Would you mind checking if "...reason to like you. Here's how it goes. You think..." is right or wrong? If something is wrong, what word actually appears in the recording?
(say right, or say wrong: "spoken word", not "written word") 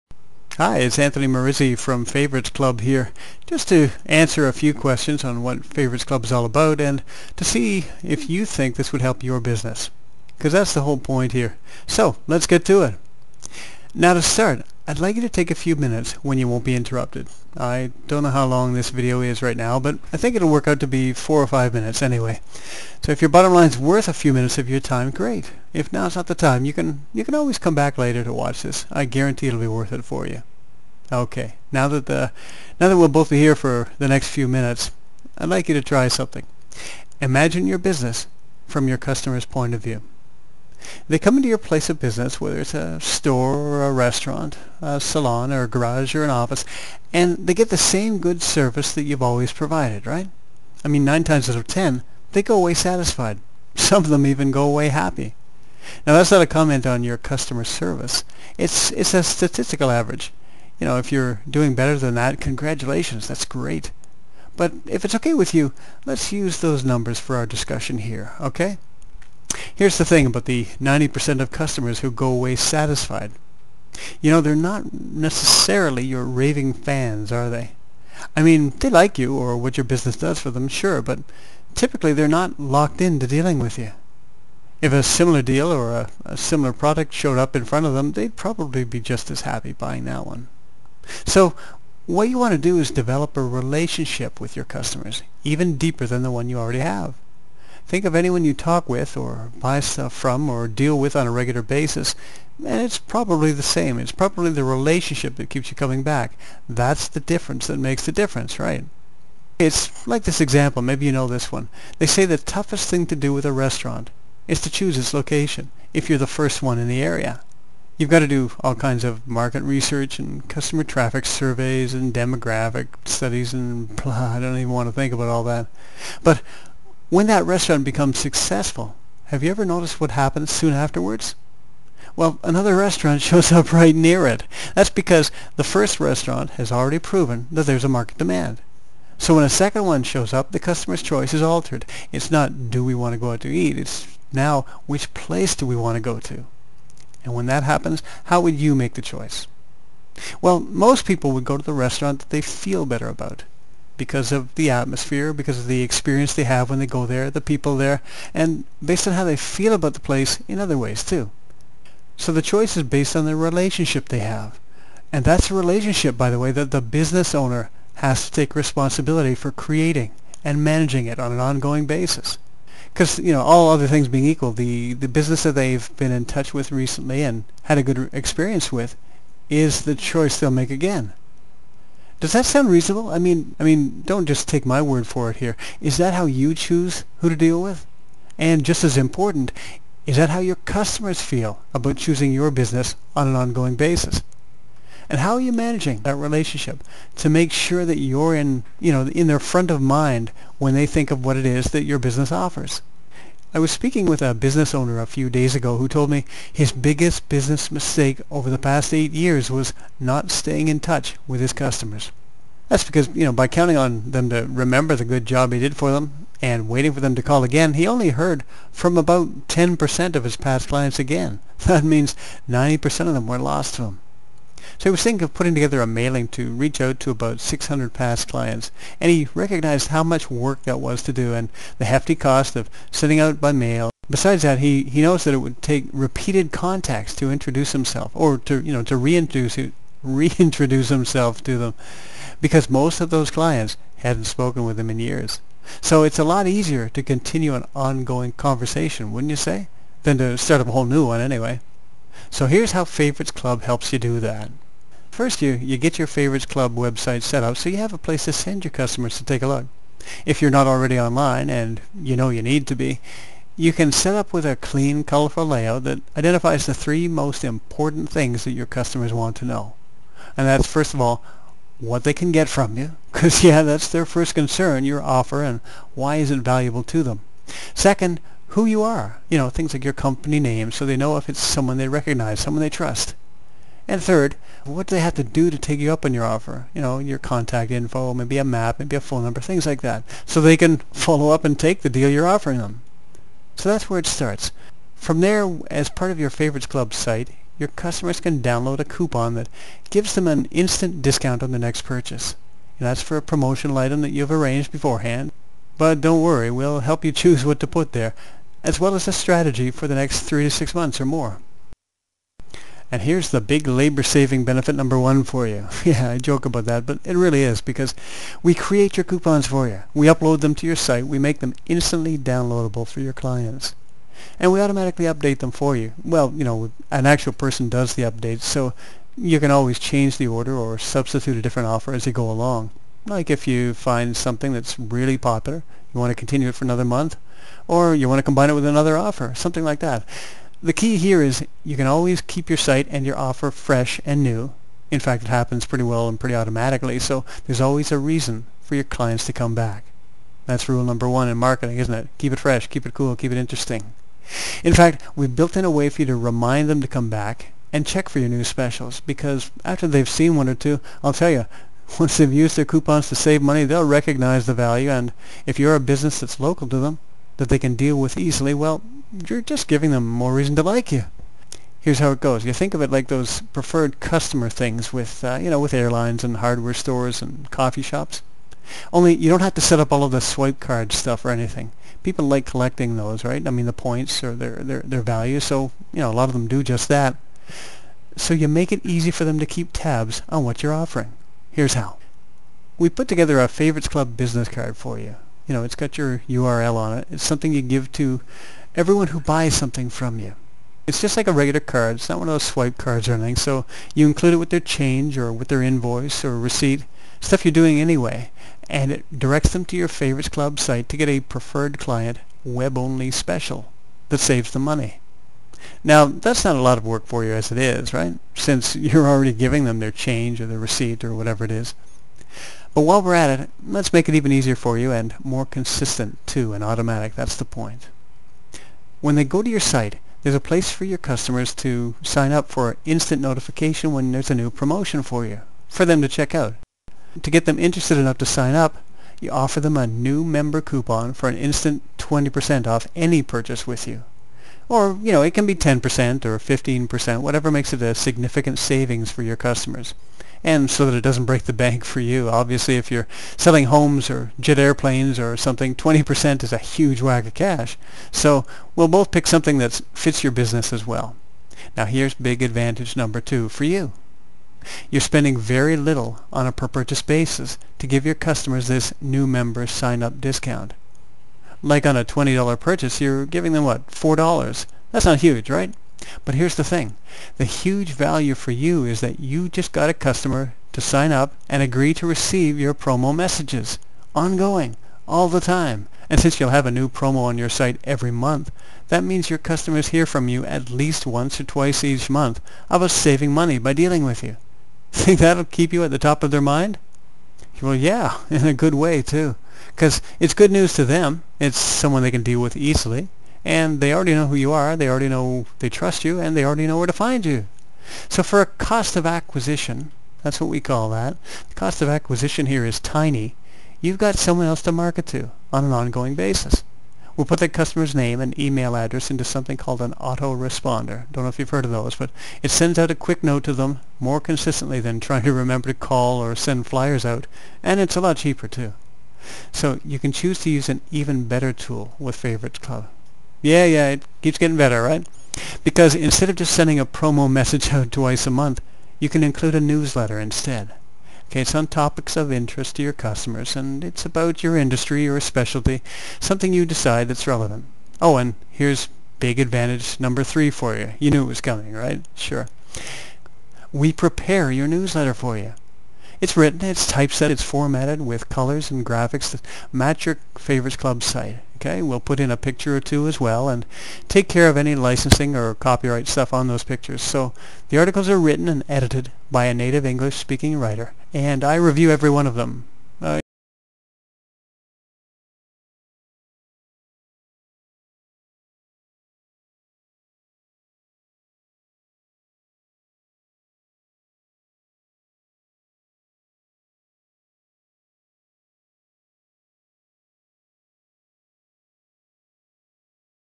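right.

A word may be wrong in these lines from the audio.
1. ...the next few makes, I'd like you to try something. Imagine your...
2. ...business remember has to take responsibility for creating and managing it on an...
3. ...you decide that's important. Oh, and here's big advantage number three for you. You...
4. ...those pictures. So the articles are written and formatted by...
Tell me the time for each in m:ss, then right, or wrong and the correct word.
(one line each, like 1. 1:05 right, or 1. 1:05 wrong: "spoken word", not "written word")
1. 0:33 wrong: "minutes", not "makes"
2. 2:46 wrong: "owner", not "remember"
3. 9:06 wrong: "relevant", not "important"
4. 9:26 wrong: "edited", not "formatted".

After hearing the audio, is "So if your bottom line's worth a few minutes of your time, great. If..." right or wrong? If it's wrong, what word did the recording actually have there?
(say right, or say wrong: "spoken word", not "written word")
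right.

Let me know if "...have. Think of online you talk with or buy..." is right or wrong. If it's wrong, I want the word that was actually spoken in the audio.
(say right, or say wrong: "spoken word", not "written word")
wrong: "anyone", not "online".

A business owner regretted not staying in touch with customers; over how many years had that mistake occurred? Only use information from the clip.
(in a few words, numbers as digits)
8 years.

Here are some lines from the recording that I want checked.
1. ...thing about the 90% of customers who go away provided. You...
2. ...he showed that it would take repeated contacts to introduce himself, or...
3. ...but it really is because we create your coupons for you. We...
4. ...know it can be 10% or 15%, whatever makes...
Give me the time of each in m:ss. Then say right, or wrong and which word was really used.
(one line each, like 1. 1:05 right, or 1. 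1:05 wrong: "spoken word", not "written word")
1. 1:10 wrong: "satisfied", not "provided"
2. 3:54 wrong: "noticed", not "showed"
3. 5:16 right
4. 7:25 right.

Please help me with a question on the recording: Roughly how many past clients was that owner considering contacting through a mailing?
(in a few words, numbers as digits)
600.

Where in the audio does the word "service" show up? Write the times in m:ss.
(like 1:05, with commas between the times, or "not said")
0:48, 0:57.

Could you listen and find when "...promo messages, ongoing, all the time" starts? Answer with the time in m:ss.
8:02.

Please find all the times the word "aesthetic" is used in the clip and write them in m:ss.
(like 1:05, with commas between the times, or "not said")
not said.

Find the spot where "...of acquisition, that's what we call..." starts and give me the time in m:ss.
8:28.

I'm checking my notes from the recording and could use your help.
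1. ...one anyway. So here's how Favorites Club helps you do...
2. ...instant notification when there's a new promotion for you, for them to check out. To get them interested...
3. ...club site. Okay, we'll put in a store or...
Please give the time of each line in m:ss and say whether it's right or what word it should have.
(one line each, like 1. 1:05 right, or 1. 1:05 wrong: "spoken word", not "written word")
1. 4:11 right
2. 7:12 right
3. 9:20 wrong: "picture", not "store".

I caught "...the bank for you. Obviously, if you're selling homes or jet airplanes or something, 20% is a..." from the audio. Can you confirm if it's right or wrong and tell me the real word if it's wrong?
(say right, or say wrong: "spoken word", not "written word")
right.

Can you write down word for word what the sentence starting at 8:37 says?
We'll put the customer's name and email address into something called an autoresponder.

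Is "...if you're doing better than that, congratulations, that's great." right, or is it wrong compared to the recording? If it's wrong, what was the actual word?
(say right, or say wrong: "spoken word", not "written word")
right.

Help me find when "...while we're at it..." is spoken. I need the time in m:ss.
7:02.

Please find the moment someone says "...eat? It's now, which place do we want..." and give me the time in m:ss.
2:23.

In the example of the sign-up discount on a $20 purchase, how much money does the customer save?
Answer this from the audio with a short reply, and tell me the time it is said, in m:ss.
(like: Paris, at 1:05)
$4, at 7:53.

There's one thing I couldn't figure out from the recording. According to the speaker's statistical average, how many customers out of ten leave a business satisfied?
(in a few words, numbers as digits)
9.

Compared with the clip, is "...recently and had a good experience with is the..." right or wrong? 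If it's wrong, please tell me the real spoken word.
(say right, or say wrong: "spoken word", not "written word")
right.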